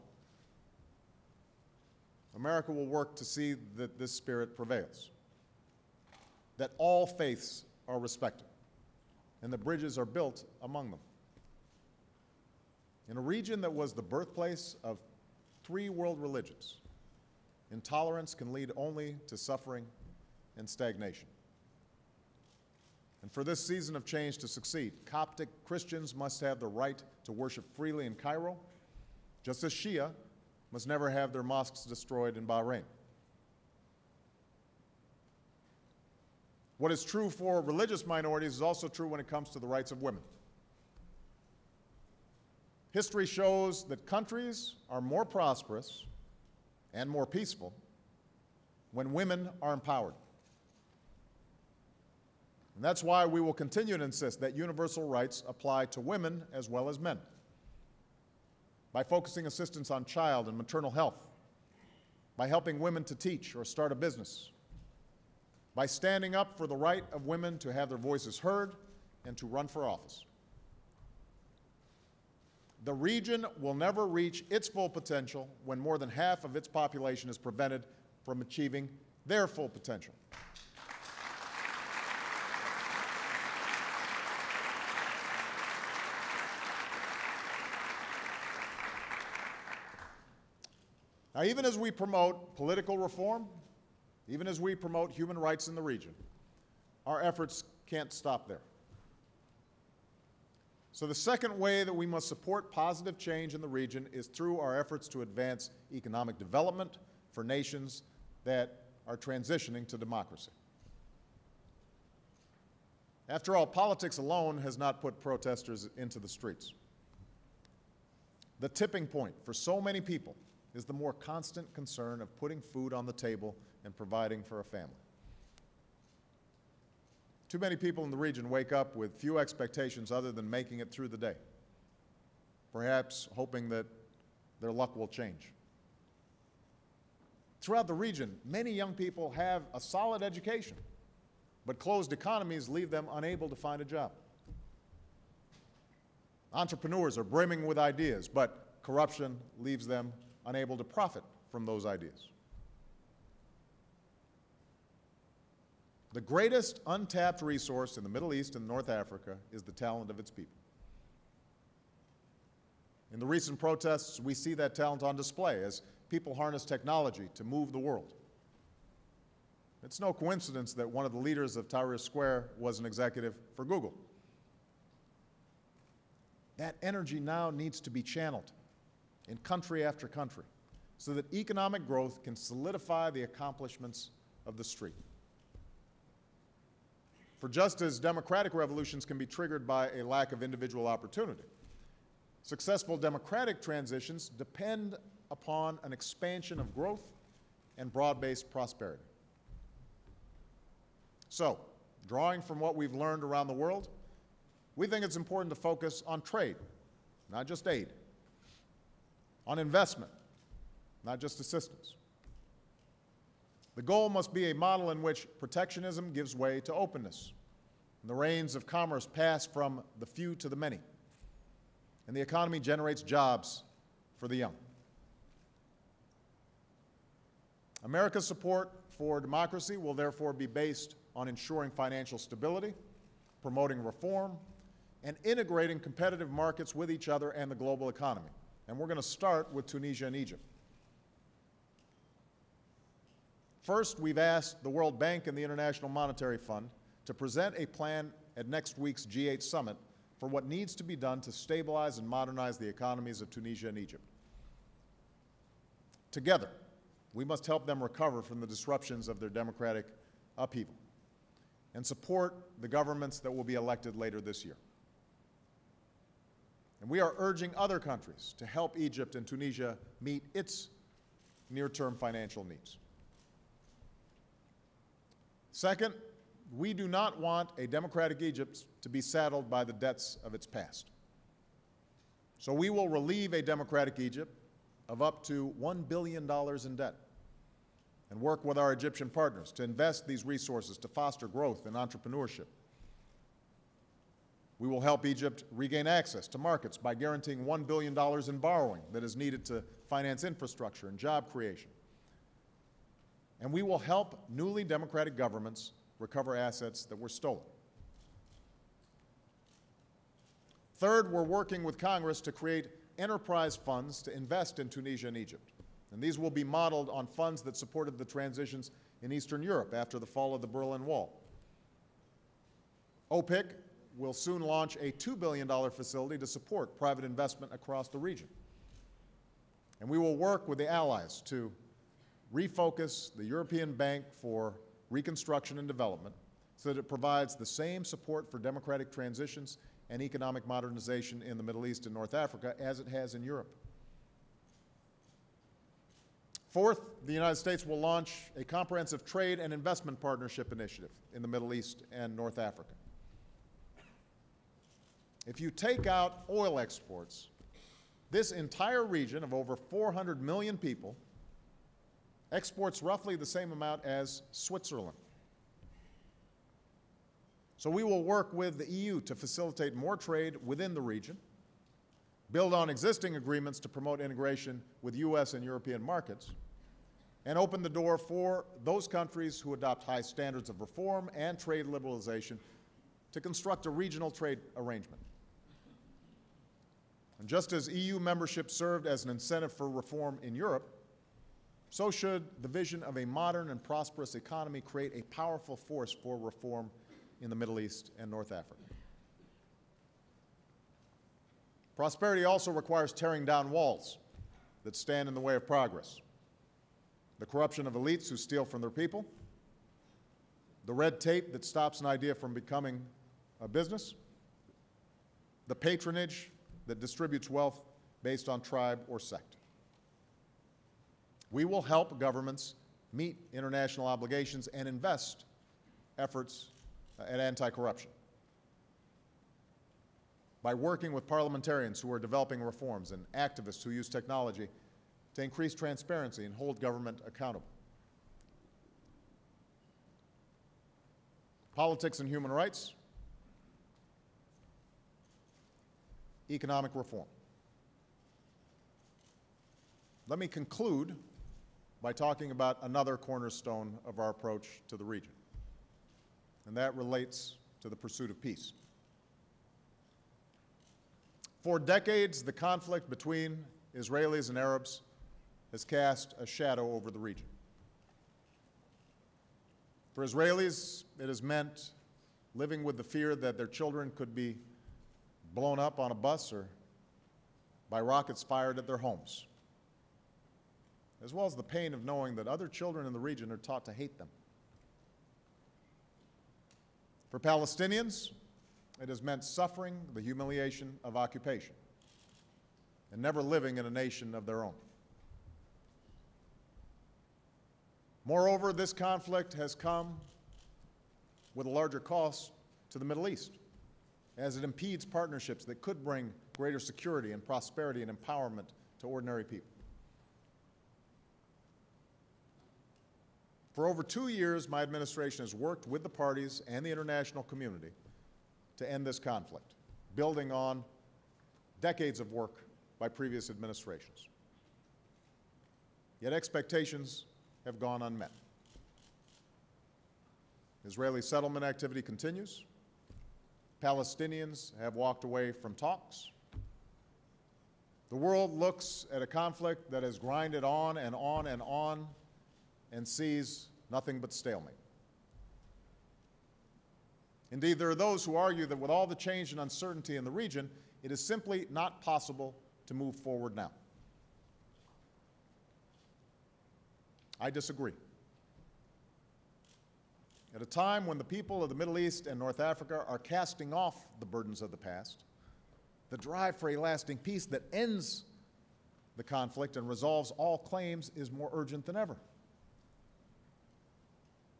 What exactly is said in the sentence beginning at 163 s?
In the recent protests, we see that talent on display as people harness technology to move the world.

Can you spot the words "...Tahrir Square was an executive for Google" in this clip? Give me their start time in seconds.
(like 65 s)
171 s.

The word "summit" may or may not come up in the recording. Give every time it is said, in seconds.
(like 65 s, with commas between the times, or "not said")
249 s.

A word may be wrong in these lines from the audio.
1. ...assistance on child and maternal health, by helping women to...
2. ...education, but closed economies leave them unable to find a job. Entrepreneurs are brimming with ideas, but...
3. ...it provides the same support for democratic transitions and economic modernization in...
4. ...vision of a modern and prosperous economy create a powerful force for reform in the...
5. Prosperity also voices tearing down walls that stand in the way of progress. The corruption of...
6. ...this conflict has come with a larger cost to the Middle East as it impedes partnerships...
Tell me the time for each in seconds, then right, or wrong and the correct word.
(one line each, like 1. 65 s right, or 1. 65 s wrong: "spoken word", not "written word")
1. 59 s right
2. 140 s right
3. 336 s right
4. 392 s right
5. 401 s wrong: "requires", not "voices"
6. 498 s right.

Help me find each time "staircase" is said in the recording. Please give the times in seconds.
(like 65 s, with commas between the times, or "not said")
not said.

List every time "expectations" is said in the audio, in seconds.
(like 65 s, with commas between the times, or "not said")
129 s, 526 s.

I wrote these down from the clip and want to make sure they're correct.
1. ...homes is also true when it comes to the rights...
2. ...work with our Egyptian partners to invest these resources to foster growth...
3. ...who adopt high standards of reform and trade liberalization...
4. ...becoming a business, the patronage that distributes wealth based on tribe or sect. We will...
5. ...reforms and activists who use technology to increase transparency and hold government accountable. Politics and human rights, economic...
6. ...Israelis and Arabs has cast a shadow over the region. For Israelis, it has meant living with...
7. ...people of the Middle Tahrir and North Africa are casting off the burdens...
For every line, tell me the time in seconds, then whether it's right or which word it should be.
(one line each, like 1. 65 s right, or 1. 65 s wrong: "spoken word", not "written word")
1. 38 s wrong: "minorities", not "homes"
2. 288 s right
3. 379 s right
4. 412 s right
5. 432 s right
6. 463 s right
7. 561 s wrong: "East", not "Tahrir".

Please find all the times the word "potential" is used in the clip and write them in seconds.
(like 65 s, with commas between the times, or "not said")
74 s, 79 s.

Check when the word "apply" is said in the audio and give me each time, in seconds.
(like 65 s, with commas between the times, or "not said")
55 s.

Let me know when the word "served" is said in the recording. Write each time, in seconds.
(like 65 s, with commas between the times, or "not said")
388 s.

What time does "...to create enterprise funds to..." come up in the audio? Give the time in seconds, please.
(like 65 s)
312 s.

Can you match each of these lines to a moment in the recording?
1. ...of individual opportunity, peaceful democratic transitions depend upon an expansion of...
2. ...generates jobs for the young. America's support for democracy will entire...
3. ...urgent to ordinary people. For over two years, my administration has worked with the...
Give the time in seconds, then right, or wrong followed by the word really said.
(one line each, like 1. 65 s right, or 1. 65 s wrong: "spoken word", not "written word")
1. 190 s wrong: "successful", not "peaceful"
2. 222 s wrong: "therefore", not "entire"
3. 507 s wrong: "empowerment", not "urgent".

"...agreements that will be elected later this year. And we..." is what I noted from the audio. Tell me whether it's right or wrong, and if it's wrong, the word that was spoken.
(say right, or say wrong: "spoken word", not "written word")
wrong: "governments", not "agreements".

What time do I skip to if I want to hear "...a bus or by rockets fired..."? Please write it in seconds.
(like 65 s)
475 s.